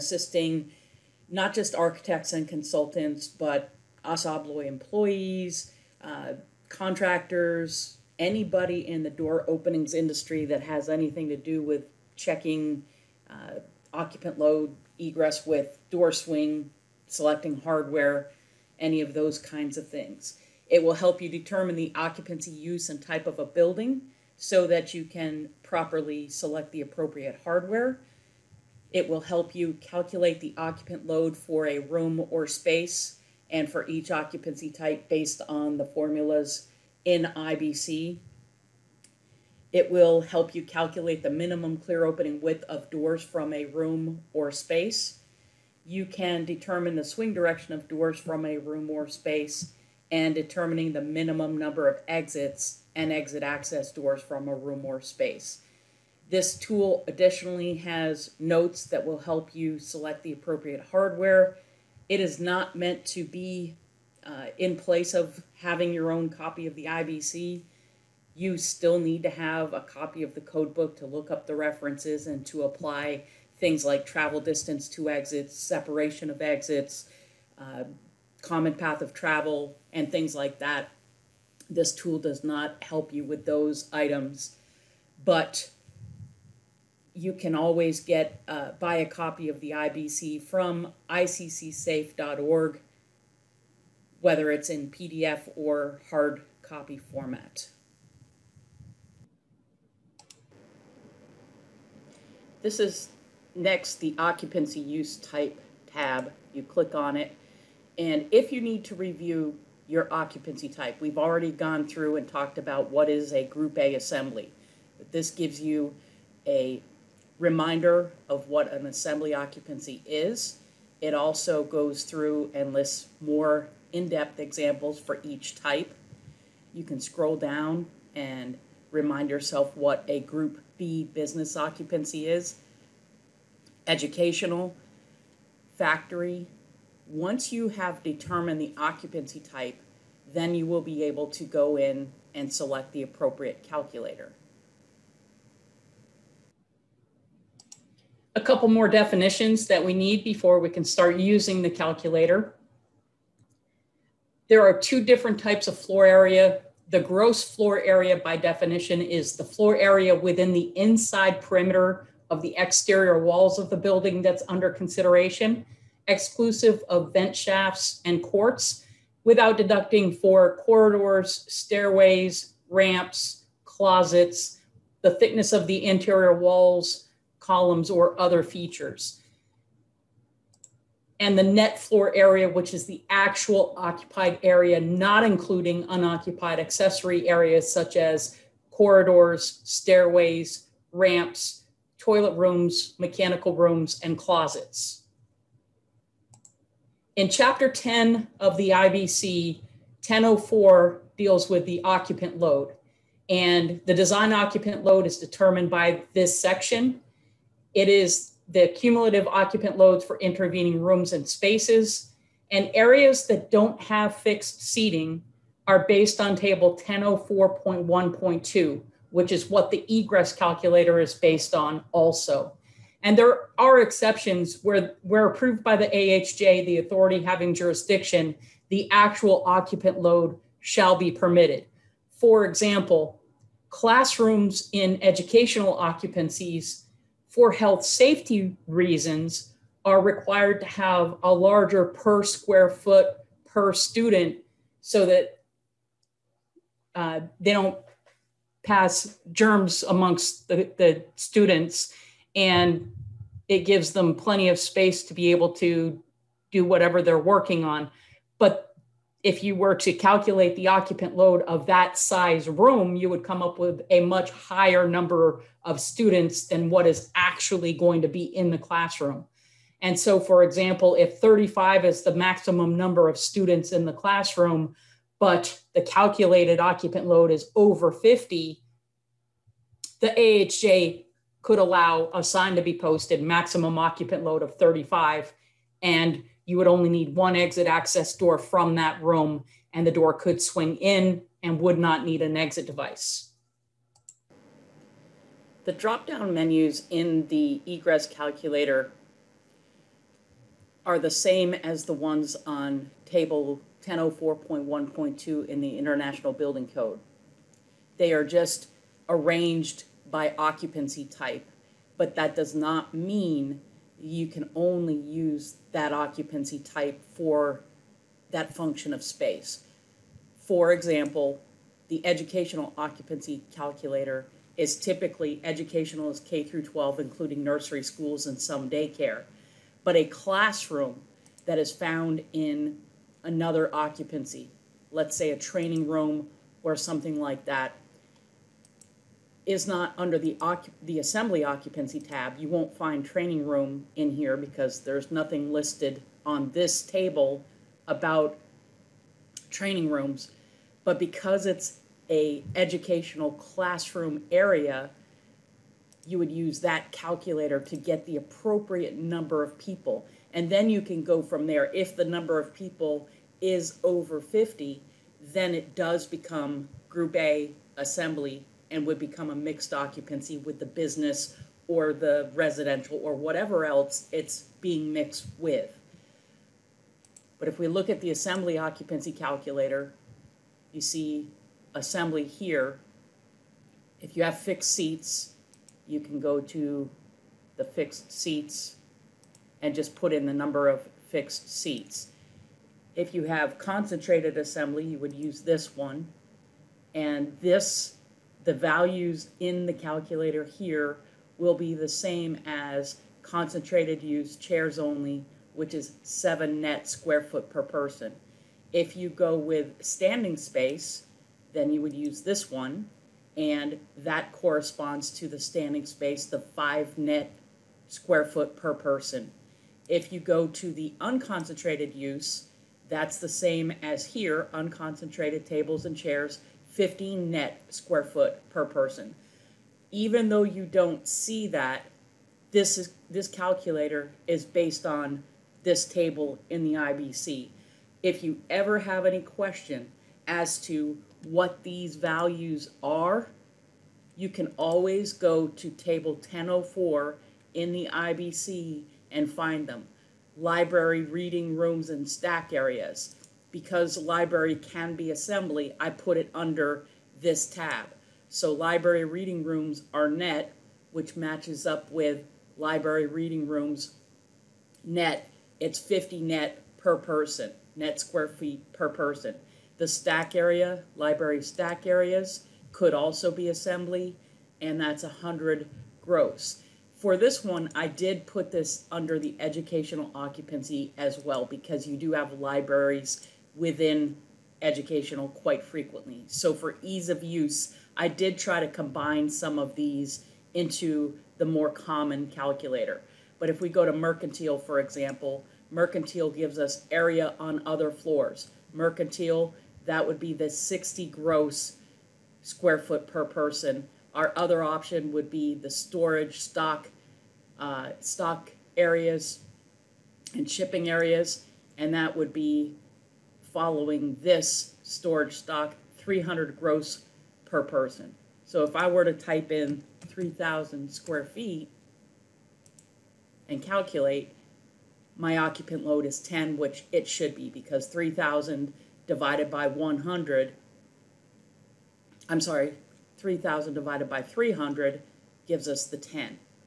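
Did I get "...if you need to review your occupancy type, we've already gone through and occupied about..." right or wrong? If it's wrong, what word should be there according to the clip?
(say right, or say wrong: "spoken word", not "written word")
wrong: "talked", not "occupied".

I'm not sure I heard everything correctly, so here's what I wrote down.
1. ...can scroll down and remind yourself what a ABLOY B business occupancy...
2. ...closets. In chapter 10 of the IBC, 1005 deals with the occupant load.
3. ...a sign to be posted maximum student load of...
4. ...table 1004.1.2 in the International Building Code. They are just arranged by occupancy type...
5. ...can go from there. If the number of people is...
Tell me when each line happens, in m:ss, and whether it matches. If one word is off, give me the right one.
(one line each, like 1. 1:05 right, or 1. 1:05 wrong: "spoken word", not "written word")
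1. 2:06 wrong: "Group", not "ABLOY"
2. 3:14 wrong: "1004", not "1005"
3. 4:42 wrong: "occupant", not "student"
4. 5:03 right
5. 6:00 right.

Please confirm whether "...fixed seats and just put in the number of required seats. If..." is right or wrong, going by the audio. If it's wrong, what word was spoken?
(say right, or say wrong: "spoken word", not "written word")
wrong: "fixed", not "required".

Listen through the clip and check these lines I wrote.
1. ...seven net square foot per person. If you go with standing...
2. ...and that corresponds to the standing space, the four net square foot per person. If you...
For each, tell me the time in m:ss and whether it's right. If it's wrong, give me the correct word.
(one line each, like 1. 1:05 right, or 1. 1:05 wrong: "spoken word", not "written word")
1. 6:46 right
2. 6:53 wrong: "five", not "four".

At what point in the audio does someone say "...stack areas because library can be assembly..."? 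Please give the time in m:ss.
7:32.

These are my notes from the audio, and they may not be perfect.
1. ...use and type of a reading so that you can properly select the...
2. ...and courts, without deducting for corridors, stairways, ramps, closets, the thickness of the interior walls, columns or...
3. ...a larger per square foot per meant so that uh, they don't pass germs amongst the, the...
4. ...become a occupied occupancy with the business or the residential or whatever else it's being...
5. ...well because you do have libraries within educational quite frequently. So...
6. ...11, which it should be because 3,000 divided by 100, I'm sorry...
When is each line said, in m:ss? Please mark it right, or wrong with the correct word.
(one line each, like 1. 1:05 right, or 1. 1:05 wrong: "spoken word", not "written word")
1. 0:22 wrong: "building", not "reading"
2. 2:48 right
3. 4:01 wrong: "student", not "meant"
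4. 6:08 wrong: "mixed", not "occupied"
5. 8:01 right
6. 8:46 wrong: "10", not "11".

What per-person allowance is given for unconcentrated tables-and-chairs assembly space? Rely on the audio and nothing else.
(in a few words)
15 net square feet.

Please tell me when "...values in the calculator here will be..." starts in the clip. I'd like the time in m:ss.
6:38.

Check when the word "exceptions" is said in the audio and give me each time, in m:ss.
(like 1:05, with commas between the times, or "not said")
3:43.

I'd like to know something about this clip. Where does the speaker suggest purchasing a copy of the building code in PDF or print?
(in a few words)
iccsafe.org.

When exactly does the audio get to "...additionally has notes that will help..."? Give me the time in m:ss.
0:57.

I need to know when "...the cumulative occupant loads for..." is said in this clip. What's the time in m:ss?
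3:28.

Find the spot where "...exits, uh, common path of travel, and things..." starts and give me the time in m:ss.
1:16.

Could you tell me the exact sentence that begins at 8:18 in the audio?
Mercantile, that would be the 60 gross square foot per person.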